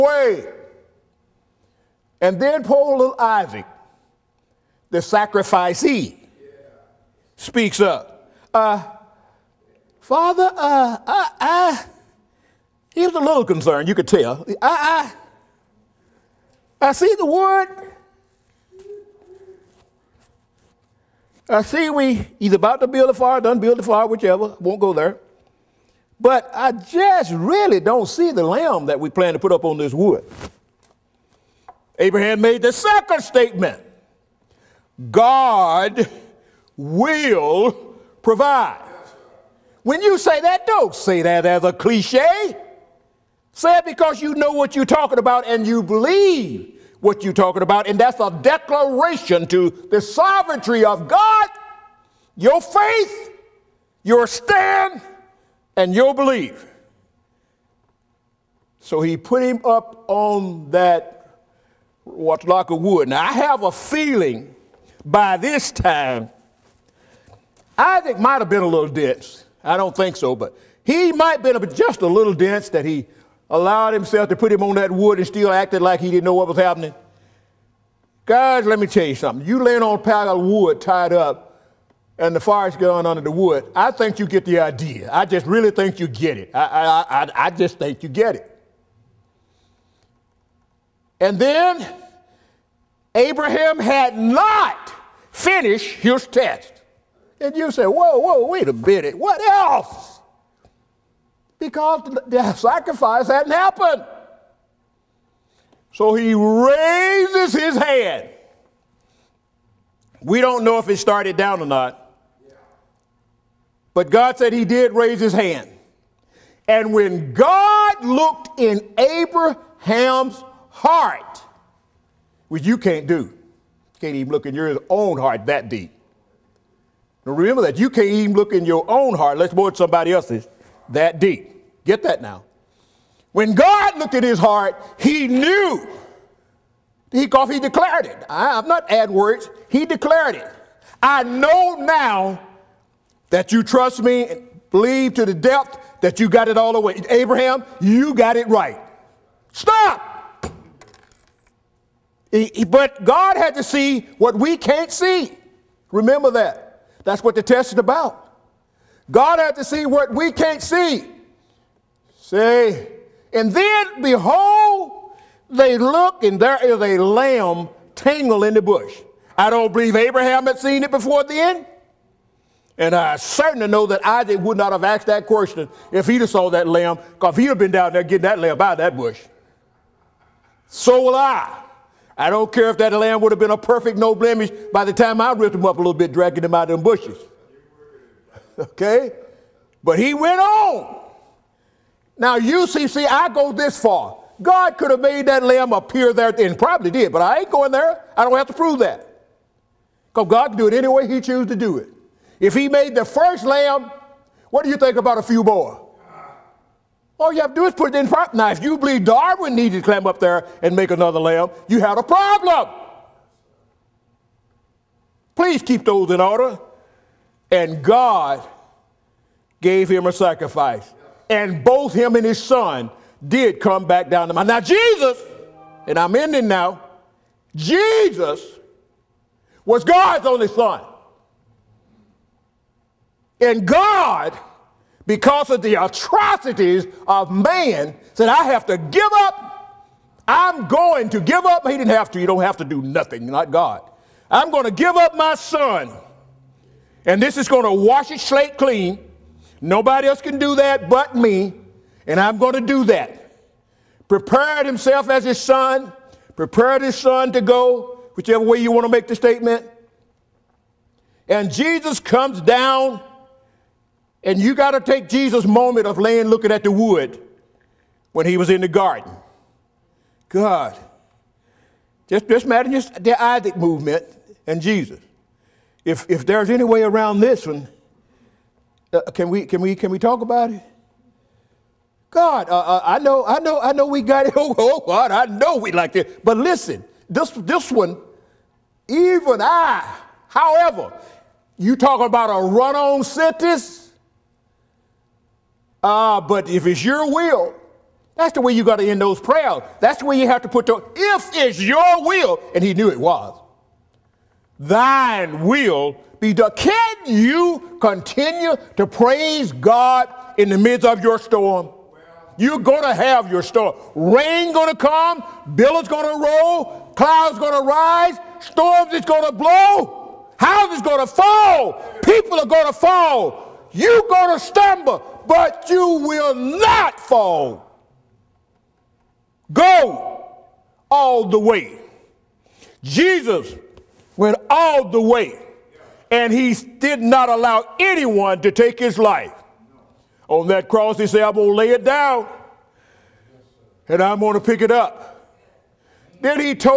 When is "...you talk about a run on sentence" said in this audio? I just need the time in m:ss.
4:51.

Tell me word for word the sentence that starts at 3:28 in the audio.
Now, if you believe Darwin needed to climb up there and make another lamb, you had a problem.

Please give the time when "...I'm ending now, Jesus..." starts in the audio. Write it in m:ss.
3:45.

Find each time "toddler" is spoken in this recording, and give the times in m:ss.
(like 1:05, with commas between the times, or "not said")
not said.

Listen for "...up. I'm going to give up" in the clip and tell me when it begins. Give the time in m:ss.
3:59.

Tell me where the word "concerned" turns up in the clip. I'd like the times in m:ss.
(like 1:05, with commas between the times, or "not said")
0:13.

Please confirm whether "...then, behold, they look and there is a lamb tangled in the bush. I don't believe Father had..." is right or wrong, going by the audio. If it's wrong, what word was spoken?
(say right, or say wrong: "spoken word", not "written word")
wrong: "Abraham", not "Father".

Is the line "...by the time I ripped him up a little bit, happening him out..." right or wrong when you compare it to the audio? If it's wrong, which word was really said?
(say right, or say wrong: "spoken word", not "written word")
wrong: "dragging", not "happening".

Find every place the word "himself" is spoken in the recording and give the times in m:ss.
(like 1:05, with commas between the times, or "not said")
1:13, 4:14.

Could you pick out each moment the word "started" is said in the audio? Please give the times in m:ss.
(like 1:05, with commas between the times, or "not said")
1:50.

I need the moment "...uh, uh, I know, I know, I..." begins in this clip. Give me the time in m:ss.
4:42.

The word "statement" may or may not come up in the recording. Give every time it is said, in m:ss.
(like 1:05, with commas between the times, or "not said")
0:33, 4:19.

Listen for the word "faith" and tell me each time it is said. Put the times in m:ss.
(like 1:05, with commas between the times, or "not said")
0:52.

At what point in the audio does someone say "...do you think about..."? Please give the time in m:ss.
3:24.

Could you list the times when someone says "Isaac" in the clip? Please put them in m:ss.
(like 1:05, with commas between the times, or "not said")
0:03, 1:07, 2:54, 4:33.